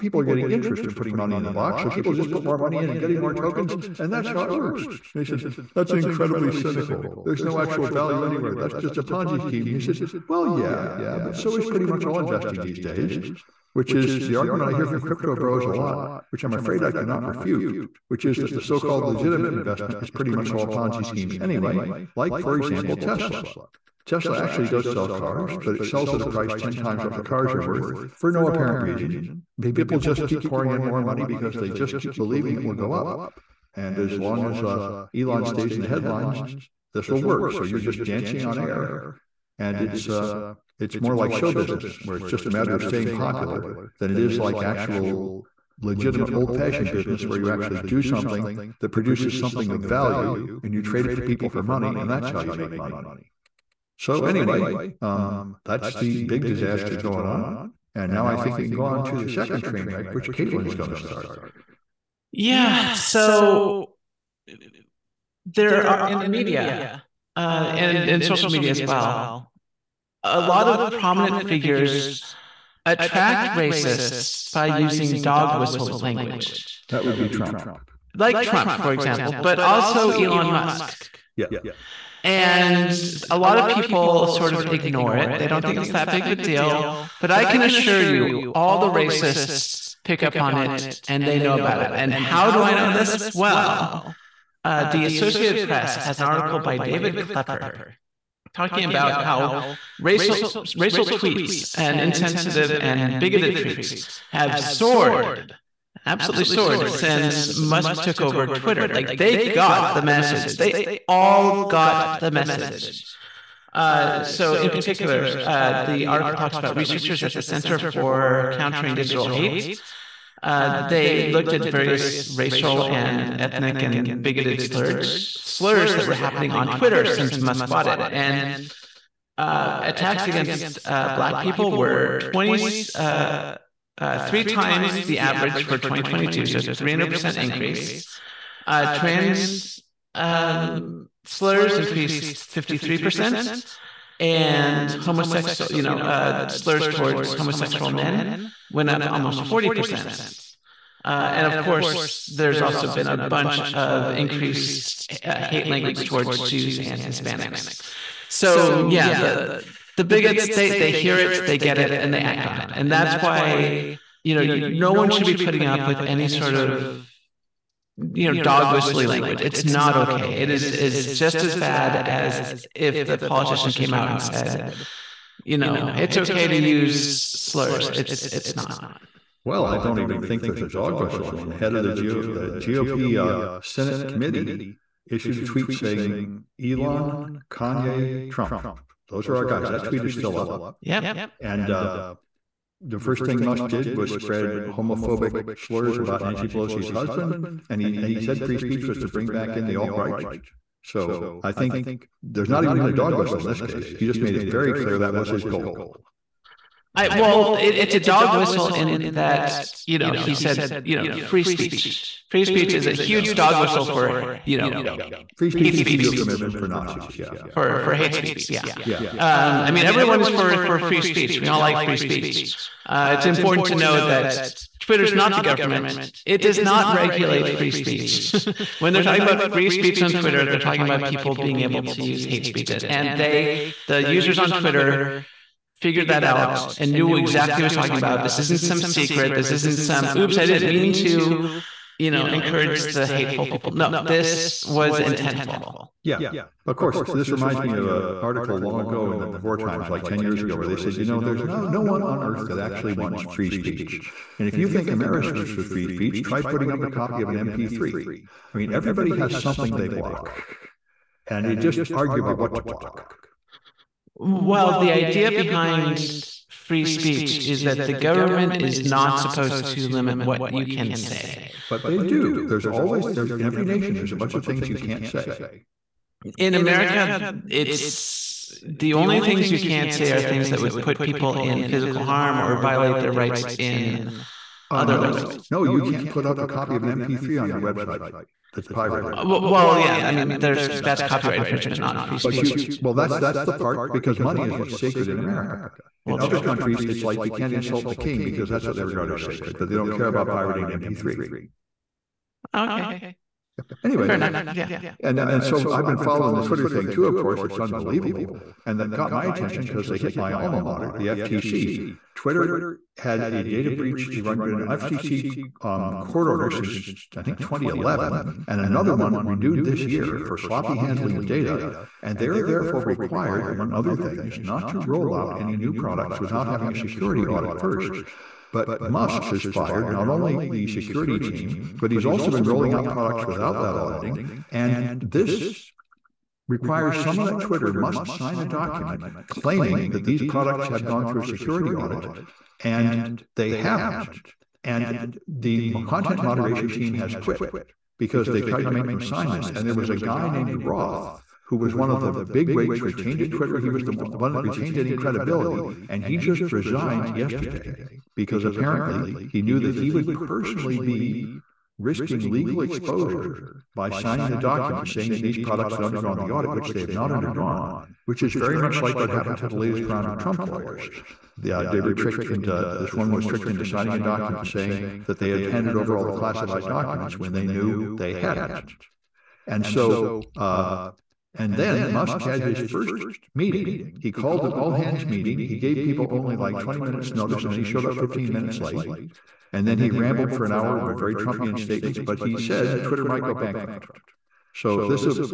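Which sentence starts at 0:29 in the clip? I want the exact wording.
People just keep pouring in more money because they just keep believing it will go up.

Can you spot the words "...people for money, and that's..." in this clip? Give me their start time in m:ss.
0:51.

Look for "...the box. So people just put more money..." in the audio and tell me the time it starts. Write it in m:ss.
0:01.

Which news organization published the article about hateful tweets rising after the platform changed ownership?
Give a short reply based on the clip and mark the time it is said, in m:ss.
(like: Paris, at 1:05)
Associated Press, at 1:35.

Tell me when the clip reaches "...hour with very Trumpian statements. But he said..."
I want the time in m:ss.
6:30.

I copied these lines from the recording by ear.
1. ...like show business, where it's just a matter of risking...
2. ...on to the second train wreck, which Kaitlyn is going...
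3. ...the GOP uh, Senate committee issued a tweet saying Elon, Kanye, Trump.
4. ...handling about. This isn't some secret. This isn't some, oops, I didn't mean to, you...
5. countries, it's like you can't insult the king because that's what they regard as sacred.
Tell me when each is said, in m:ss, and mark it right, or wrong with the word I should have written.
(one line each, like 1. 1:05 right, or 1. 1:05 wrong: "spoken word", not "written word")
1. 0:41 wrong: "staying", not "risking"
2. 0:58 right
3. 3:01 right
4. 3:57 wrong: "talking", not "handling"
5. 4:56 right.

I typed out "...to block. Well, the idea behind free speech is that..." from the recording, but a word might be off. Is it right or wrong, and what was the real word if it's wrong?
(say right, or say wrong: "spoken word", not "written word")
right.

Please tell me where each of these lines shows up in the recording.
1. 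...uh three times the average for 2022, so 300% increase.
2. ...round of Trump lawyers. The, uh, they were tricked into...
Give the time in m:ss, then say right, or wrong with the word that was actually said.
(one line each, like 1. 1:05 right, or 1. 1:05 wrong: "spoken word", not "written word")
1. 2:13 right
2. 6:09 right.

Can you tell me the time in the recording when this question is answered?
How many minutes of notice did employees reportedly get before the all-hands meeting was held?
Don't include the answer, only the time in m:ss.
6:26.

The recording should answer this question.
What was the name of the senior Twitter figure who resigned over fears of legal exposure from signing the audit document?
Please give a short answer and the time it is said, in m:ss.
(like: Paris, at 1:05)
Roth, at 5:50.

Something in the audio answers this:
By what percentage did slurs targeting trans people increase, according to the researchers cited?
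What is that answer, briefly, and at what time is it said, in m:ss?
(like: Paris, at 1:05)
53%, at 2:22.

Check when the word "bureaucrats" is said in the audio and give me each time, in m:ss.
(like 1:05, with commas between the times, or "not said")
not said.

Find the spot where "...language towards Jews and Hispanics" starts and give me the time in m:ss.
2:35.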